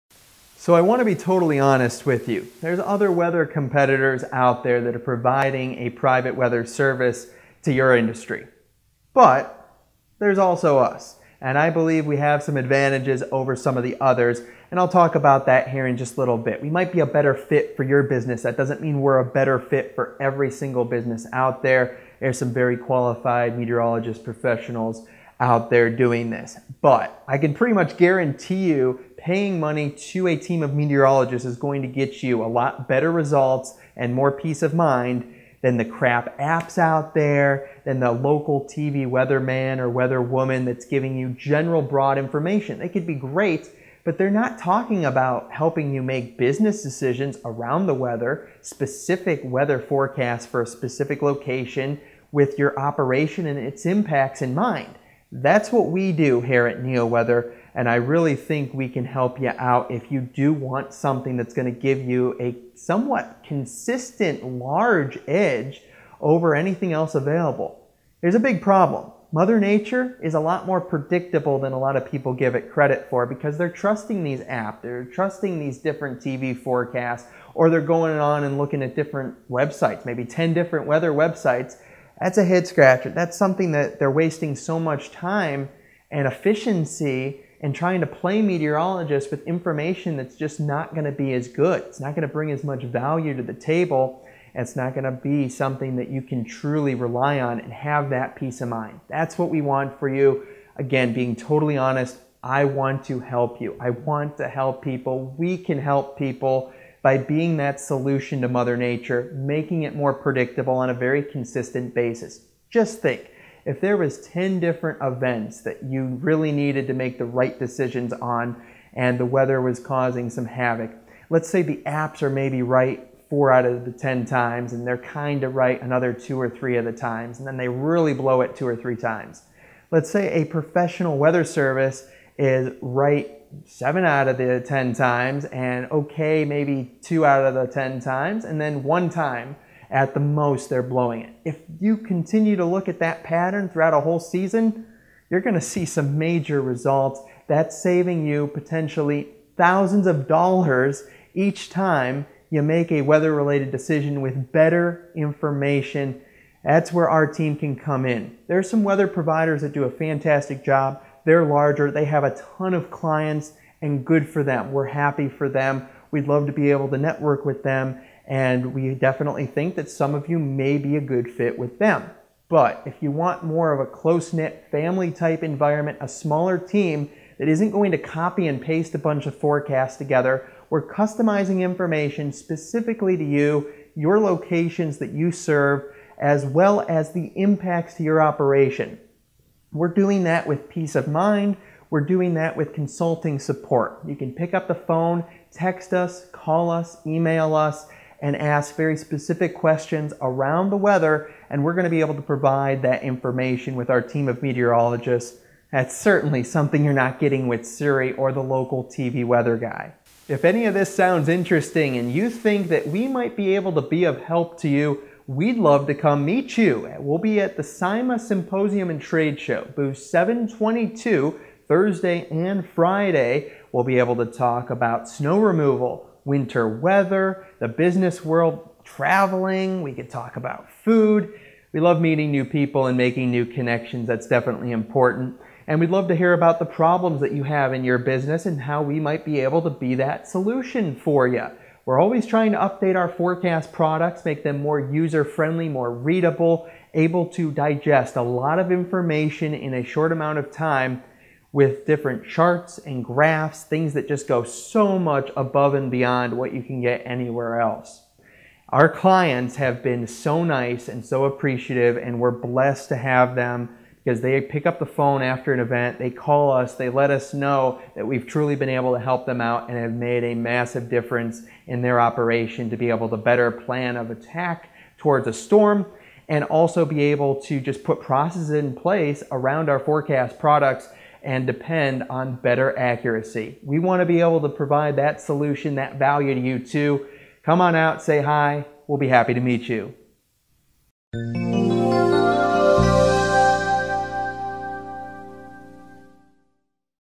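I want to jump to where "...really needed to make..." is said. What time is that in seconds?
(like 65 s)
116 s.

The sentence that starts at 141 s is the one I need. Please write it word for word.
If you continue to look at that pattern throughout a whole season, you're going to see some major results.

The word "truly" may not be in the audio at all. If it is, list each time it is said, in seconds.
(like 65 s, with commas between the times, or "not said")
96 s, 268 s.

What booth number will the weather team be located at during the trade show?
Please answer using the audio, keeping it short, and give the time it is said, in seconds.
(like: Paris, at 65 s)
722, at 219 s.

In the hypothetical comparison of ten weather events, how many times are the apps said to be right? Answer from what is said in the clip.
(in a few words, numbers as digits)
4.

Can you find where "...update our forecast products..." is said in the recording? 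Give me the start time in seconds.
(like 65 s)
242 s.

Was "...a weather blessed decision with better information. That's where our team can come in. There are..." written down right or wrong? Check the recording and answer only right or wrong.
wrong.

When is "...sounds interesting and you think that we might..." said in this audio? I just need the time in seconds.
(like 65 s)
210 s.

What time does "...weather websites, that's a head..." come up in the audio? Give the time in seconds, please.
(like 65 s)
80 s.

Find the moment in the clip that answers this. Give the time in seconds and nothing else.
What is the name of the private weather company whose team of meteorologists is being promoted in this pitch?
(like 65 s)
56 s.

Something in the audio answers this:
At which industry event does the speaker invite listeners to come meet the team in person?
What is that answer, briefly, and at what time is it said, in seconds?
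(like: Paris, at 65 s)
SIMA Symposium and Trade Show, at 217 s.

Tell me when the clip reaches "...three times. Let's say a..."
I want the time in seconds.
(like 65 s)
128 s.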